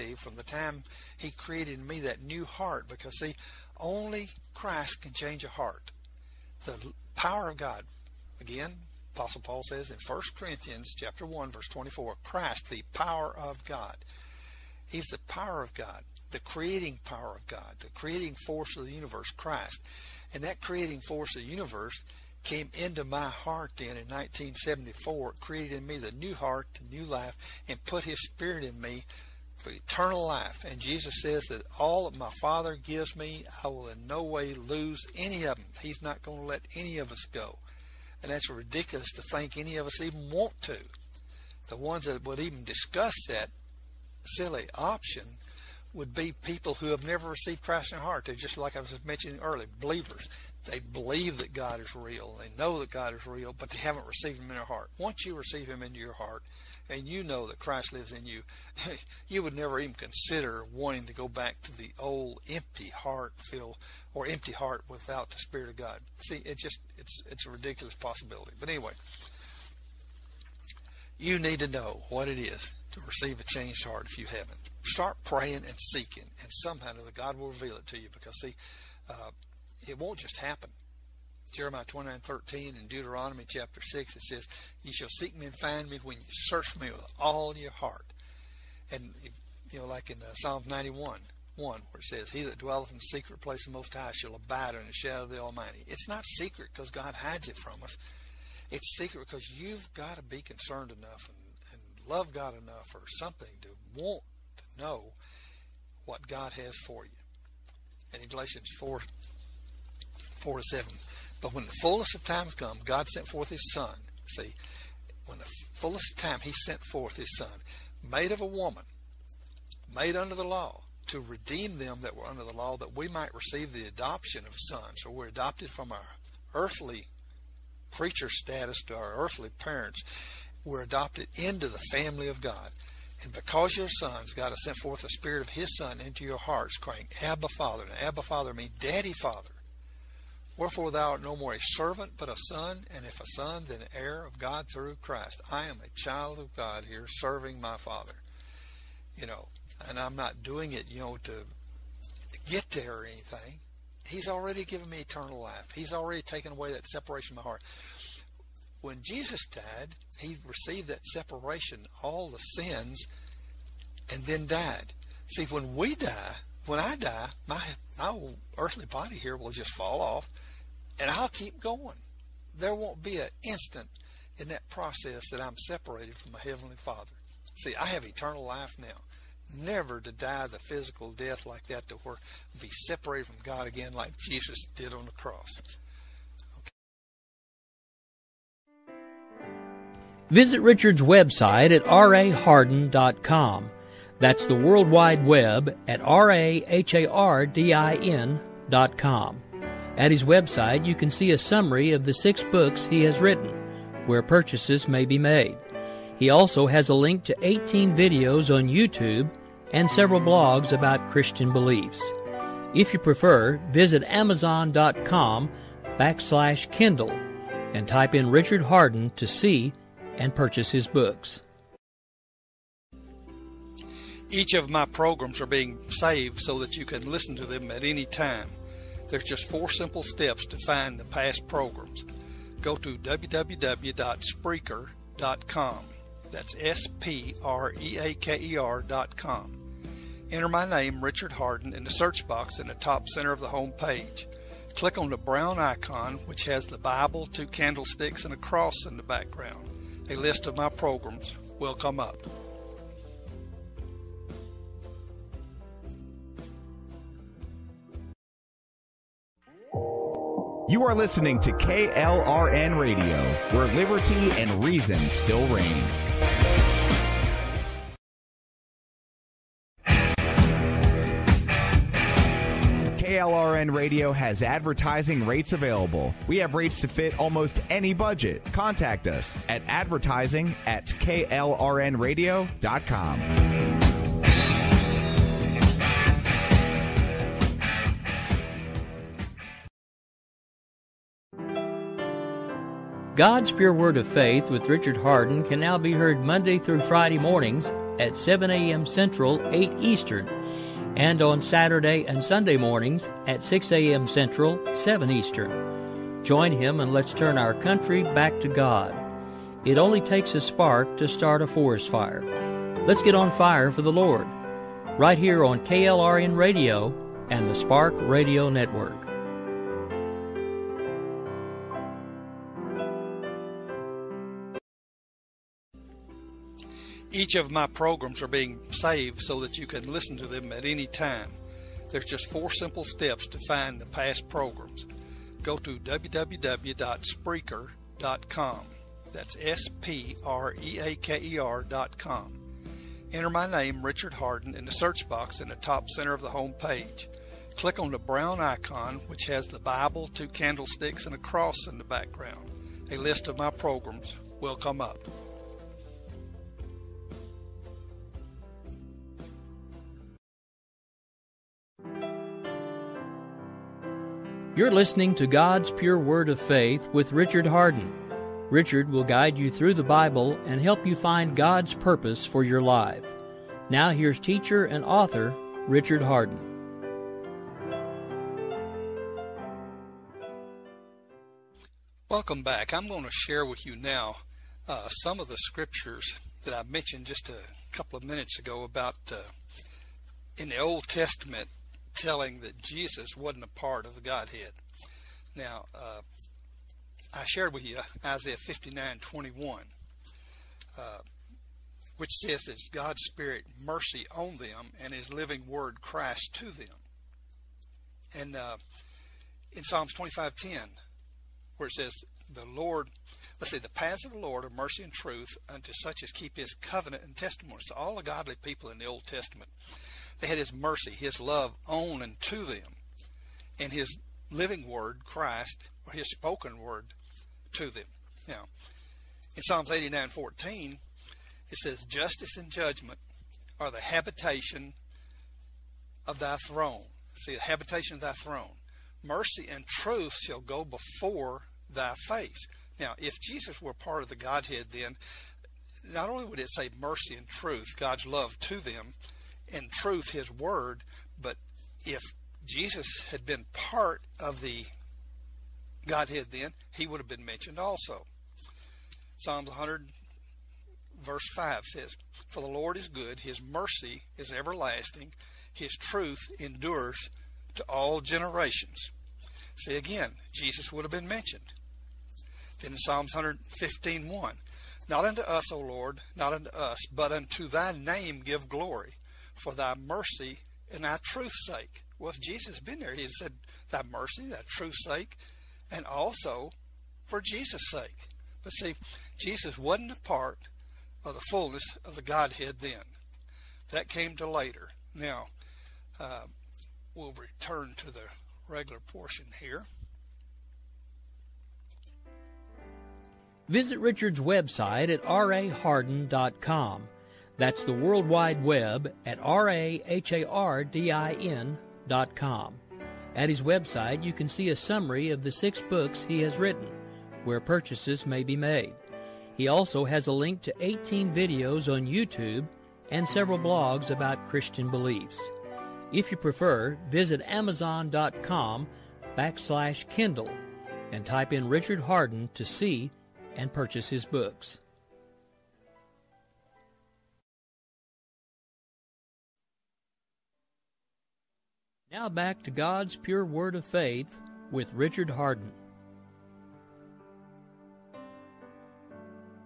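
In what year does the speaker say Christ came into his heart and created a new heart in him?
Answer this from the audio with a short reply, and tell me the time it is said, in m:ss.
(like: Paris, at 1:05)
1974, at 0:24.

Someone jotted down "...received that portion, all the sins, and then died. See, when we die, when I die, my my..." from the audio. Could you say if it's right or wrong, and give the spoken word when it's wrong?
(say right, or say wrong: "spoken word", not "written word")
wrong: "separation", not "portion".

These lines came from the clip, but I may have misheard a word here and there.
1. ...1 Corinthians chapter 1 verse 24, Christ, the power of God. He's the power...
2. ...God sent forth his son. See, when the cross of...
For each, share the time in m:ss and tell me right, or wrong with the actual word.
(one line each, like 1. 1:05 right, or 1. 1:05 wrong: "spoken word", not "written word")
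1. 0:10 right
2. 1:52 wrong: "fullness", not "cross".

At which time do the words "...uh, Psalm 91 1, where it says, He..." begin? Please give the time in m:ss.
1:30.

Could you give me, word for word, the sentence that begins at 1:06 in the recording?
See, it just it's it's a ridiculous possibility.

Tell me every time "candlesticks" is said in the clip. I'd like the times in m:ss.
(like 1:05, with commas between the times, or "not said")
4:07, 5:50.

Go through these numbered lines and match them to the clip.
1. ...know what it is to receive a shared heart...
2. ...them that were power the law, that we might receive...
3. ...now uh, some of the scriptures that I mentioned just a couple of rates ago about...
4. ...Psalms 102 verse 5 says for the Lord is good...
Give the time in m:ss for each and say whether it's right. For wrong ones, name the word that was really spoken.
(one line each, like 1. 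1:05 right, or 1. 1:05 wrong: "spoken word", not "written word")
1. 1:11 wrong: "changed", not "shared"
2. 2:01 wrong: "under", not "power"
3. 6:23 wrong: "minutes", not "rates"
4. 7:39 wrong: "100", not "102".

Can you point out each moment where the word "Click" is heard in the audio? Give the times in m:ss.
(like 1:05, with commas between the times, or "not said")
4:04, 5:47.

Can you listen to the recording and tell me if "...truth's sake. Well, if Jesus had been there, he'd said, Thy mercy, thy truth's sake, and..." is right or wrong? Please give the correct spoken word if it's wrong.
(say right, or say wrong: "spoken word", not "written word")
right.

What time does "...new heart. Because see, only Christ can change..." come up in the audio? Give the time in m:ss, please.
0:02.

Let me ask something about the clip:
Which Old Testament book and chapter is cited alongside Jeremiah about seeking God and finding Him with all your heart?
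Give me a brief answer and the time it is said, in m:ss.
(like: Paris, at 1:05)
Deuteronomy chapter 6, at 1:22.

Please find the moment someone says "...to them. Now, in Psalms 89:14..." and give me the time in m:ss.
7:07.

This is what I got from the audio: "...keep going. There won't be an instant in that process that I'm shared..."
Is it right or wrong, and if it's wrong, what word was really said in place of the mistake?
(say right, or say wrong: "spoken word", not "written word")
wrong: "separated", not "shared".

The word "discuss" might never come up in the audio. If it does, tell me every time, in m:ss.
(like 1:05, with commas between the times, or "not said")
0:42.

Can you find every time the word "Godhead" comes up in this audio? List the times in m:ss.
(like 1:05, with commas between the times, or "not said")
6:34, 7:24, 7:35, 8:12.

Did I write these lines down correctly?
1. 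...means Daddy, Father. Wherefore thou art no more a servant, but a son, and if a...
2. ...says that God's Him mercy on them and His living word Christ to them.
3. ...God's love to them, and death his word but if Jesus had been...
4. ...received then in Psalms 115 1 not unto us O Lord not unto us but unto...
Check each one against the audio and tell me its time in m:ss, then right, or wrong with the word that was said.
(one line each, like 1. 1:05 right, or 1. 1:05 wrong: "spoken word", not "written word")
1. 2:18 right
2. 6:42 wrong: "Spirit", not "Him"
3. 7:27 wrong: "truth", not "death"
4. 7:51 wrong: "mentioned", not "received".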